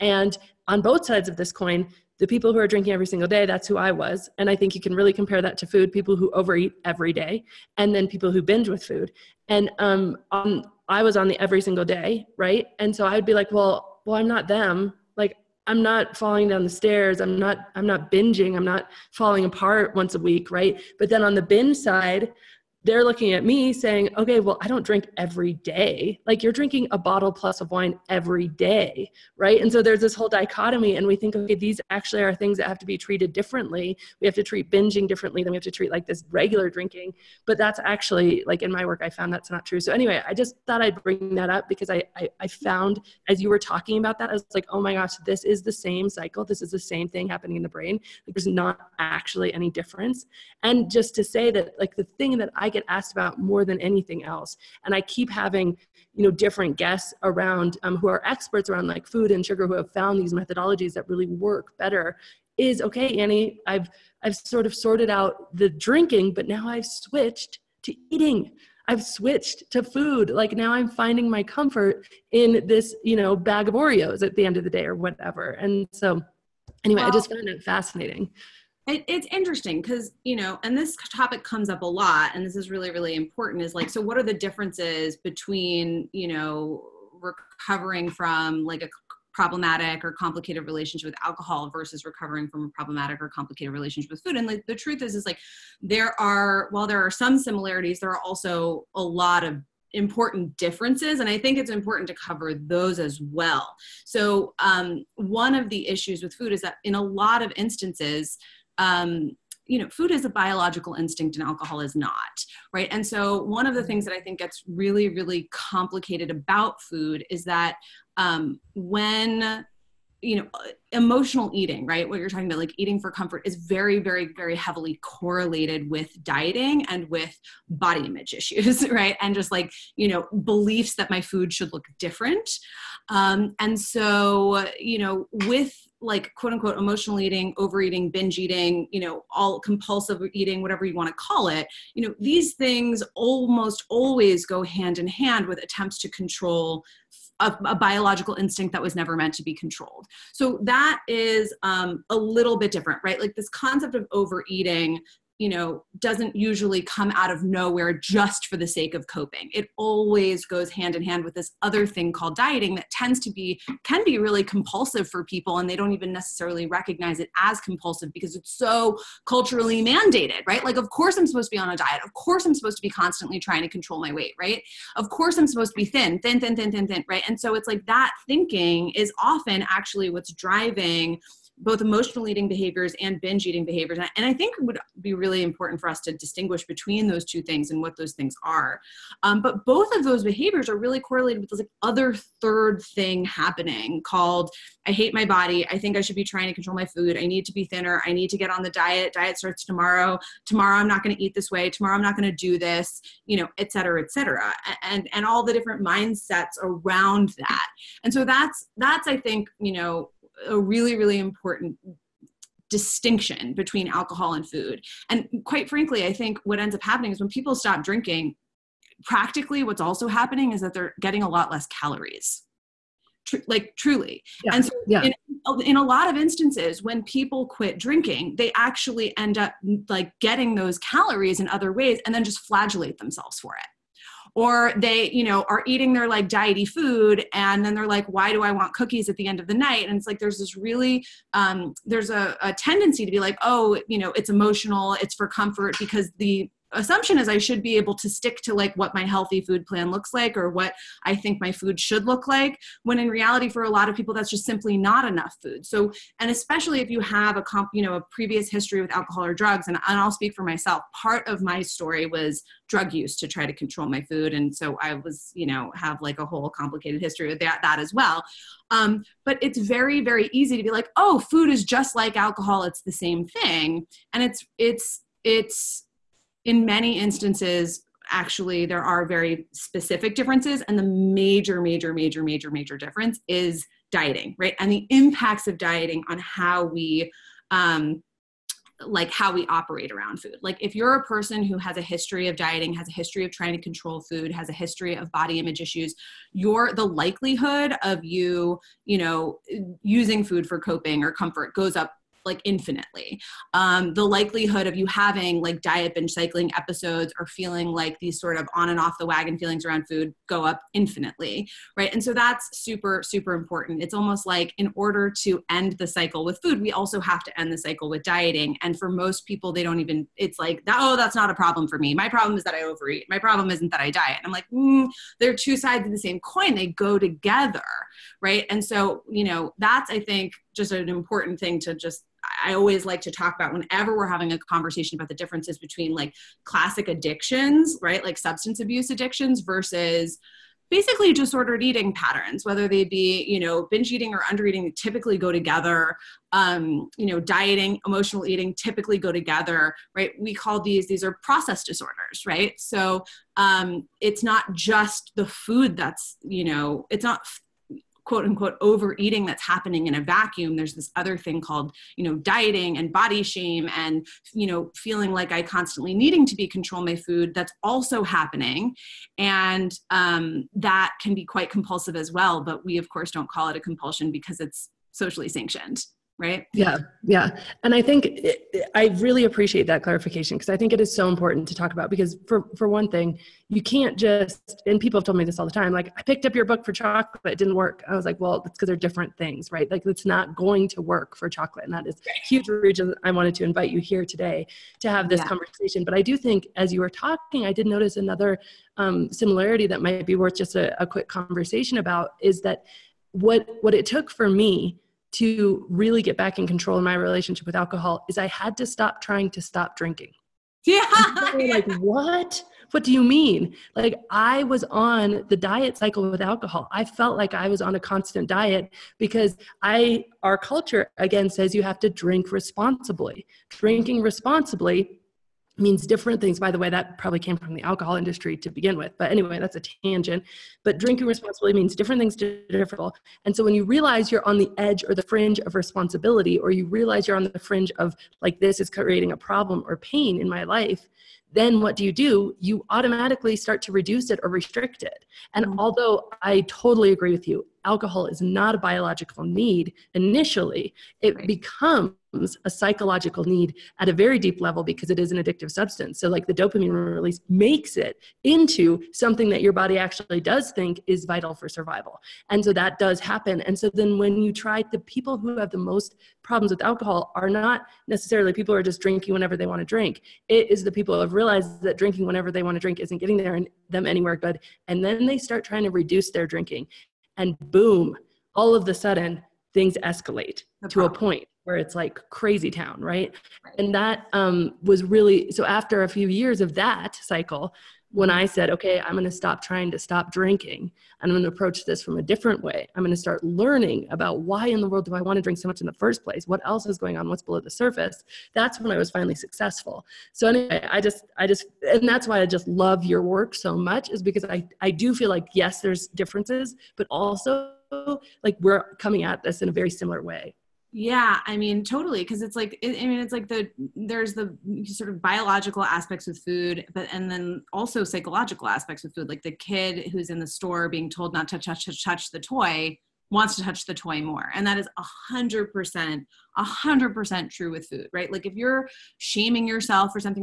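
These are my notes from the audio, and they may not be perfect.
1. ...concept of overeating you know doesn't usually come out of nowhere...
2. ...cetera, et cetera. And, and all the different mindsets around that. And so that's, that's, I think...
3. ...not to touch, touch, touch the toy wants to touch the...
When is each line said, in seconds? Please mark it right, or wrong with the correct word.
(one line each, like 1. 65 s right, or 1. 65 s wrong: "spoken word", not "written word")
1. 153 s right
2. 203 s right
3. 521 s right.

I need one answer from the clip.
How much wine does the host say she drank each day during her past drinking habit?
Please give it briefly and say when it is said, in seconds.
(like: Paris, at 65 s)
a bottle plus, at 26 s.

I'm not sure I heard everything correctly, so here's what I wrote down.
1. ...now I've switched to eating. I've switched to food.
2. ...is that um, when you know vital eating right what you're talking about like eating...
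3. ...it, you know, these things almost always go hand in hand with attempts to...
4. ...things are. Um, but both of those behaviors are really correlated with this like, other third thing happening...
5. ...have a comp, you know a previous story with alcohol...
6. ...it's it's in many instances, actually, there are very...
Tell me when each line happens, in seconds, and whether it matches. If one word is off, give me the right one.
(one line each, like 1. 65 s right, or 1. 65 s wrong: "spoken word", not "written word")
1. 66 s right
2. 117 s wrong: "emotional", not "vital"
3. 141 s right
4. 188 s right
5. 256 s wrong: "history", not "story"
6. 274 s right.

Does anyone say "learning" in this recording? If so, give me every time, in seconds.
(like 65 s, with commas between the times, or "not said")
493 s.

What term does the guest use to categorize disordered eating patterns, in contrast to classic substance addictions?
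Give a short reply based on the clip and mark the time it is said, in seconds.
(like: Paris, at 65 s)
process disorders, at 351 s.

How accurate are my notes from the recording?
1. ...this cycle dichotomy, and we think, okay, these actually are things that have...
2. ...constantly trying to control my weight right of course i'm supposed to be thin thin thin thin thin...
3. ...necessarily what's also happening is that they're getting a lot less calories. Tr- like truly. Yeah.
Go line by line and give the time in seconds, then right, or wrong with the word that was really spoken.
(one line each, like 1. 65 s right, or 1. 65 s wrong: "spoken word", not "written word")
1. 29 s wrong: "whole", not "cycle"
2. 172 s right
3. 219 s wrong: "practically", not "necessarily".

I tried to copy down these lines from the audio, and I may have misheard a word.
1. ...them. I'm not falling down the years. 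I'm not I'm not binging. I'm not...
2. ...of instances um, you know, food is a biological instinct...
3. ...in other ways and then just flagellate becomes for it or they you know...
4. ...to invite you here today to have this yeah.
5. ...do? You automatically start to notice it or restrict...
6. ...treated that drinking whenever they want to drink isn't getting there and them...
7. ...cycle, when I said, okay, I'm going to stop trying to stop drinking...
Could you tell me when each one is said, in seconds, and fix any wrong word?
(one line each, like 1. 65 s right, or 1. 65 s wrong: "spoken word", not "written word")
1. 14 s wrong: "stairs", not "years"
2. 107 s right
3. 231 s wrong: "themselves", not "becomes"
4. 393 s right
5. 441 s wrong: "reduce", not "notice"
6. 471 s wrong: "realized", not "treated"
7. 486 s right.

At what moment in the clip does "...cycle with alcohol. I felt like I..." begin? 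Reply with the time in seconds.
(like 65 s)
415 s.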